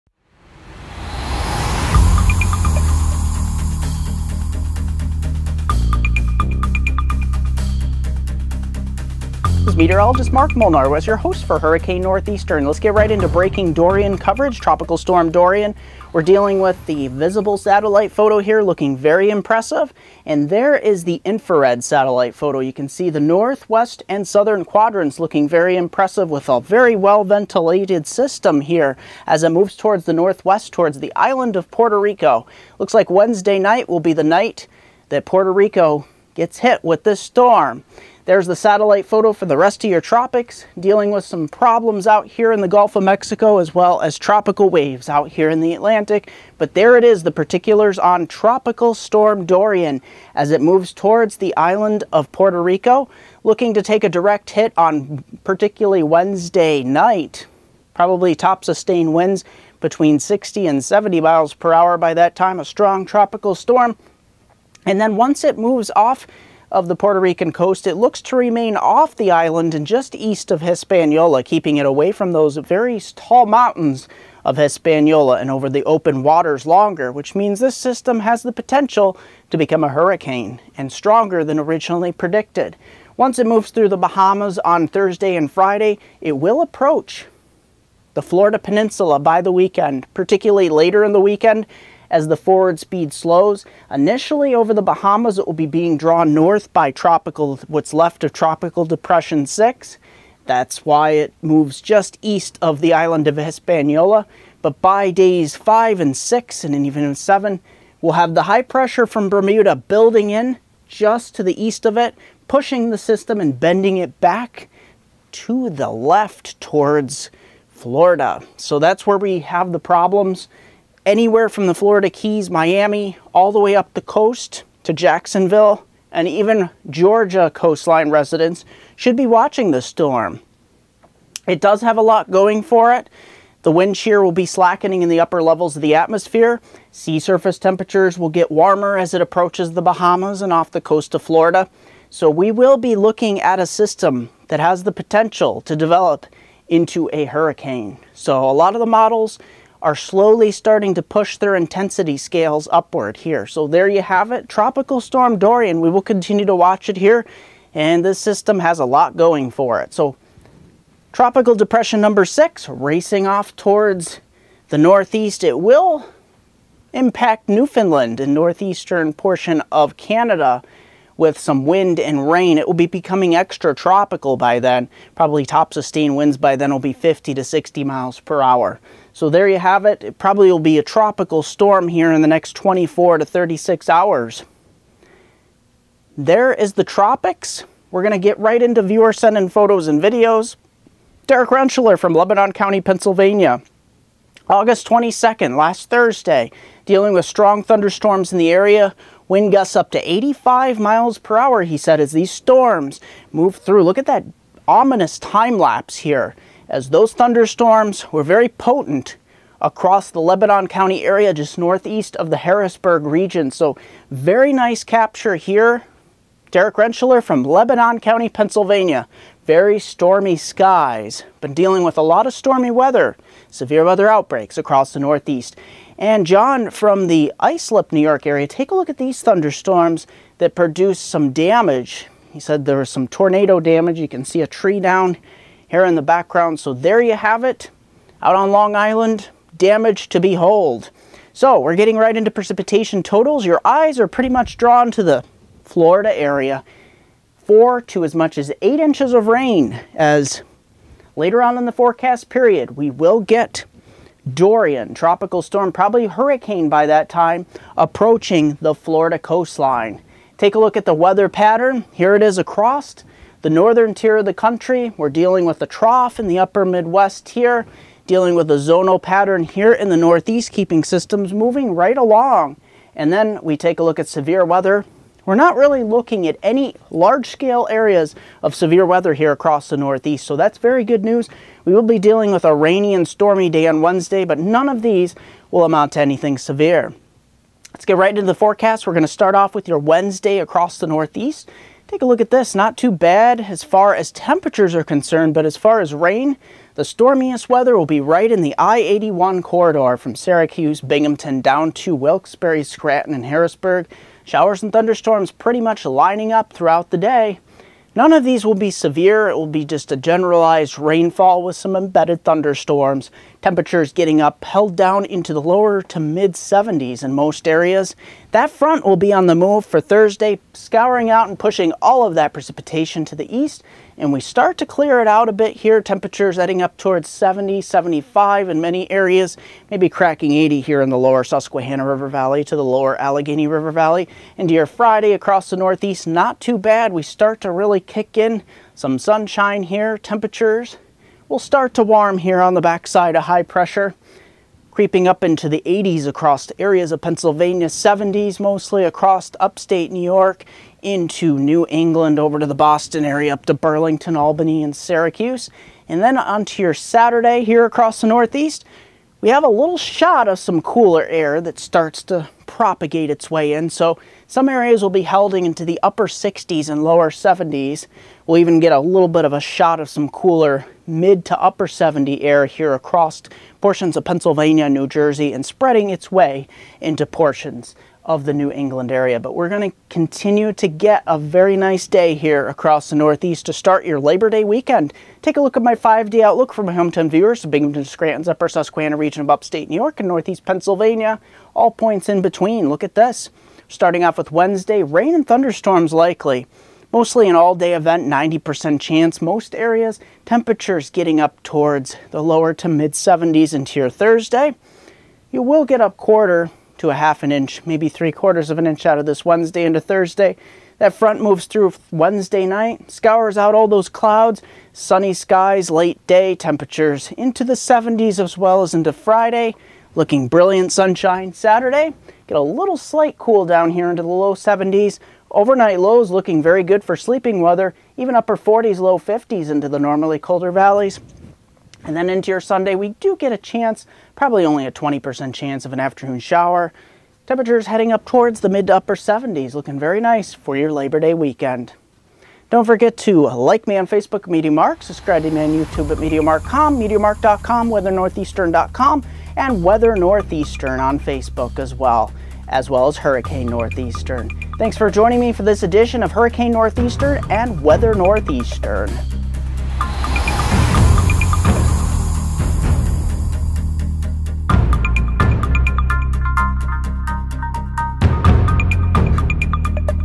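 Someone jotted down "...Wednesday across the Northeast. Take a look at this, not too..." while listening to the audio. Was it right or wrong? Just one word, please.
right.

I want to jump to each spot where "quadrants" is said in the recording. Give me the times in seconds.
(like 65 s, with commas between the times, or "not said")
24 s.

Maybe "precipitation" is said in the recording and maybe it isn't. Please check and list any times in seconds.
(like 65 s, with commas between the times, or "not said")
242 s, 322 s.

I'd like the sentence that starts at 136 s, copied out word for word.
Sea surface temperatures will get warmer as it approaches the Bahamas and off the coast of Florida.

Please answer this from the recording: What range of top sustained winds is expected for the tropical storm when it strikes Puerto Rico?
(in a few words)
60 to 70 mph.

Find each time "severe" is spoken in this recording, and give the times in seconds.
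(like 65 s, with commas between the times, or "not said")
223 s, 274 s, 278 s, 286 s, 308 s.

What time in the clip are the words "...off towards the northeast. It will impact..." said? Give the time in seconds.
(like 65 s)
163 s.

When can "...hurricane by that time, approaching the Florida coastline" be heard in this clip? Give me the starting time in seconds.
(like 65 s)
256 s.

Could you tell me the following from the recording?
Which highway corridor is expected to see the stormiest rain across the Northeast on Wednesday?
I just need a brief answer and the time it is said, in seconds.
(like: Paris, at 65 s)
I-81, at 298 s.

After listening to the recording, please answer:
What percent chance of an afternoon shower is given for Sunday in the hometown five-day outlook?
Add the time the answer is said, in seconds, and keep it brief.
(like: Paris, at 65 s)
20%, at 434 s.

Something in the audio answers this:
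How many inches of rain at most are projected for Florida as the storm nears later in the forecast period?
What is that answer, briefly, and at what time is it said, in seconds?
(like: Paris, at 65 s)
8 inches, at 248 s.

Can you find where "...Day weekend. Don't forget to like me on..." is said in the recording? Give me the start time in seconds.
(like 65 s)
440 s.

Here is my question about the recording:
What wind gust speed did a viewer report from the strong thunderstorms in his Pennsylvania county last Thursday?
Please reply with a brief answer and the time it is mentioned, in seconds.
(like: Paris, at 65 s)
85 mph, at 200 s.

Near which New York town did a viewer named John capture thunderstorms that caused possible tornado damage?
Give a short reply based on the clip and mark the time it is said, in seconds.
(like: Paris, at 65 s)
Islip, at 227 s.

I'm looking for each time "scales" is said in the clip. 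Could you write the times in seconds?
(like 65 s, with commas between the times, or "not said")
152 s, 276 s.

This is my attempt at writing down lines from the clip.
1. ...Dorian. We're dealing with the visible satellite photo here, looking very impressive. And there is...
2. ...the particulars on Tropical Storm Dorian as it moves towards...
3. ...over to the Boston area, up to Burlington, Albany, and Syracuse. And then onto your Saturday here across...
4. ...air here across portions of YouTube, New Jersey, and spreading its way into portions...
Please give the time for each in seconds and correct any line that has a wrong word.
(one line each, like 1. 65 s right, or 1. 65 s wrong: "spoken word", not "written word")
1. 15 s right
2. 47 s right
3. 352 s right
4. 372 s wrong: "Pennsylvania", not "YouTube".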